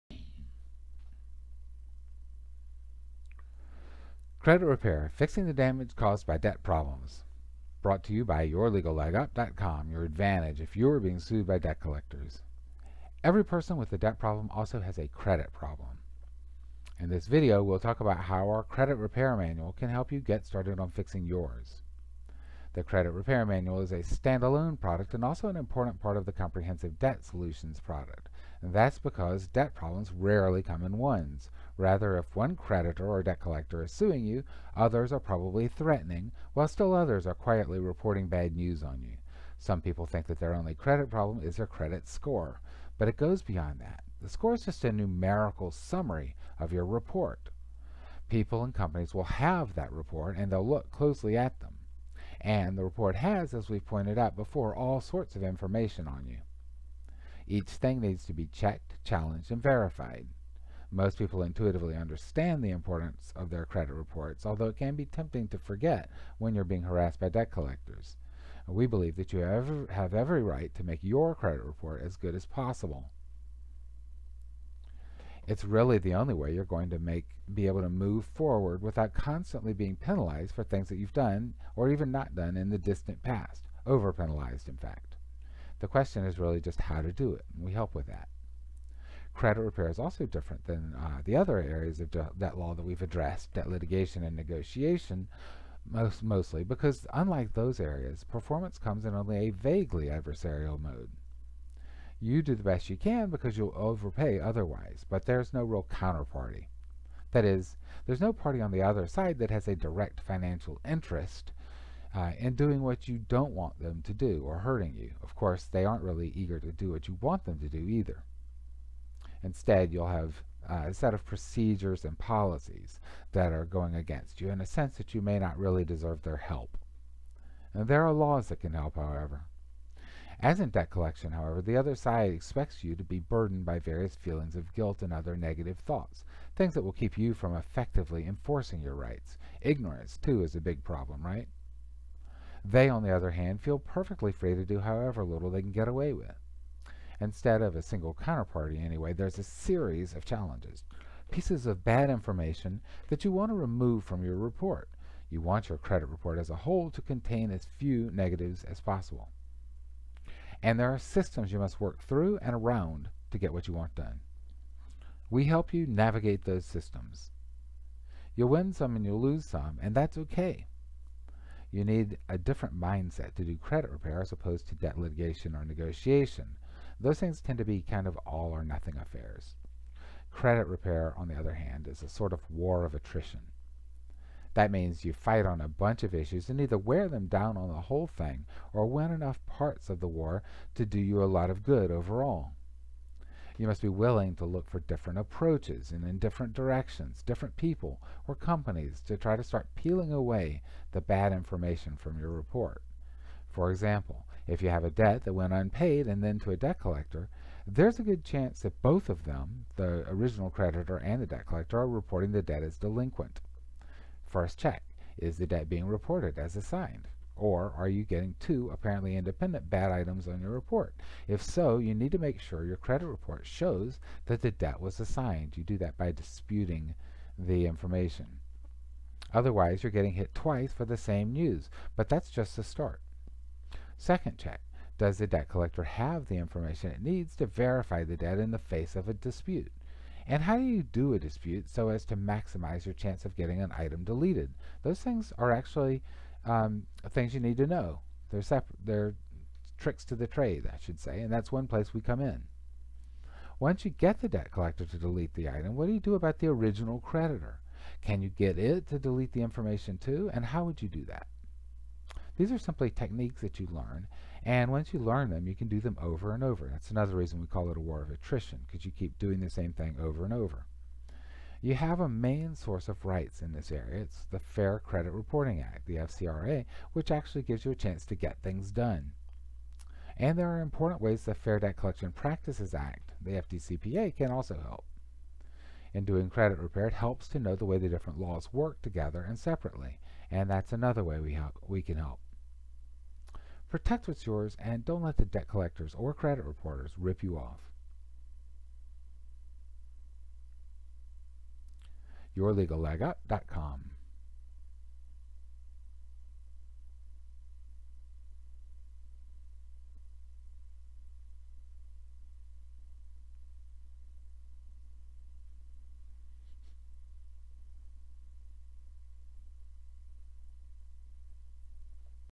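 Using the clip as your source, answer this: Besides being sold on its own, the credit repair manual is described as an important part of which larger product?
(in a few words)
comprehensive debt solutions.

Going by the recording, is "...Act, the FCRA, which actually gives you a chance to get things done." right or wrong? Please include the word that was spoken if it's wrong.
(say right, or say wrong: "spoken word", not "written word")
right.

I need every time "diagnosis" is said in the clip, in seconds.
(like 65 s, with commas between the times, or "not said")
not said.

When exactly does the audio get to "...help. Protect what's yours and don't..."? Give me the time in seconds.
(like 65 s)
291 s.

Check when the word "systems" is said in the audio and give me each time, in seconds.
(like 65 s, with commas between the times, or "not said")
160 s, 166 s.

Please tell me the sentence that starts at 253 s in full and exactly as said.
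Once you get the debt collector to delete the item, what do you do about the original creditor?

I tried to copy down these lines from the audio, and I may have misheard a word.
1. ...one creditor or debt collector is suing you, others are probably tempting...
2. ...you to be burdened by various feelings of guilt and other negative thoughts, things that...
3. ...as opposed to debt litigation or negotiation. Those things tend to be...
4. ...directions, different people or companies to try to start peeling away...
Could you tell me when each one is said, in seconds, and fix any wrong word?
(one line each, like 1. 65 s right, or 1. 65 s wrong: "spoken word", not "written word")
1. 32 s wrong: "threatening", not "tempting"
2. 132 s right
3. 174 s right
4. 196 s right.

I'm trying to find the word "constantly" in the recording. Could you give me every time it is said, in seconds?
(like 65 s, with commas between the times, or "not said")
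79 s.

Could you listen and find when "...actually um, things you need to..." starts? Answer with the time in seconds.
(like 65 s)
245 s.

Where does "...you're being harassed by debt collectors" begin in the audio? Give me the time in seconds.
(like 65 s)
66 s.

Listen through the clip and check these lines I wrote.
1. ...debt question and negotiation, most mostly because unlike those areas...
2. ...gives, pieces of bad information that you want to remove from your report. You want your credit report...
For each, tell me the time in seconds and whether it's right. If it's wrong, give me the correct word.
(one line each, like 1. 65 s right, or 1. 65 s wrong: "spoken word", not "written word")
1. 93 s wrong: "litigation", not "question"
2. 150 s wrong: "challenges", not "gives".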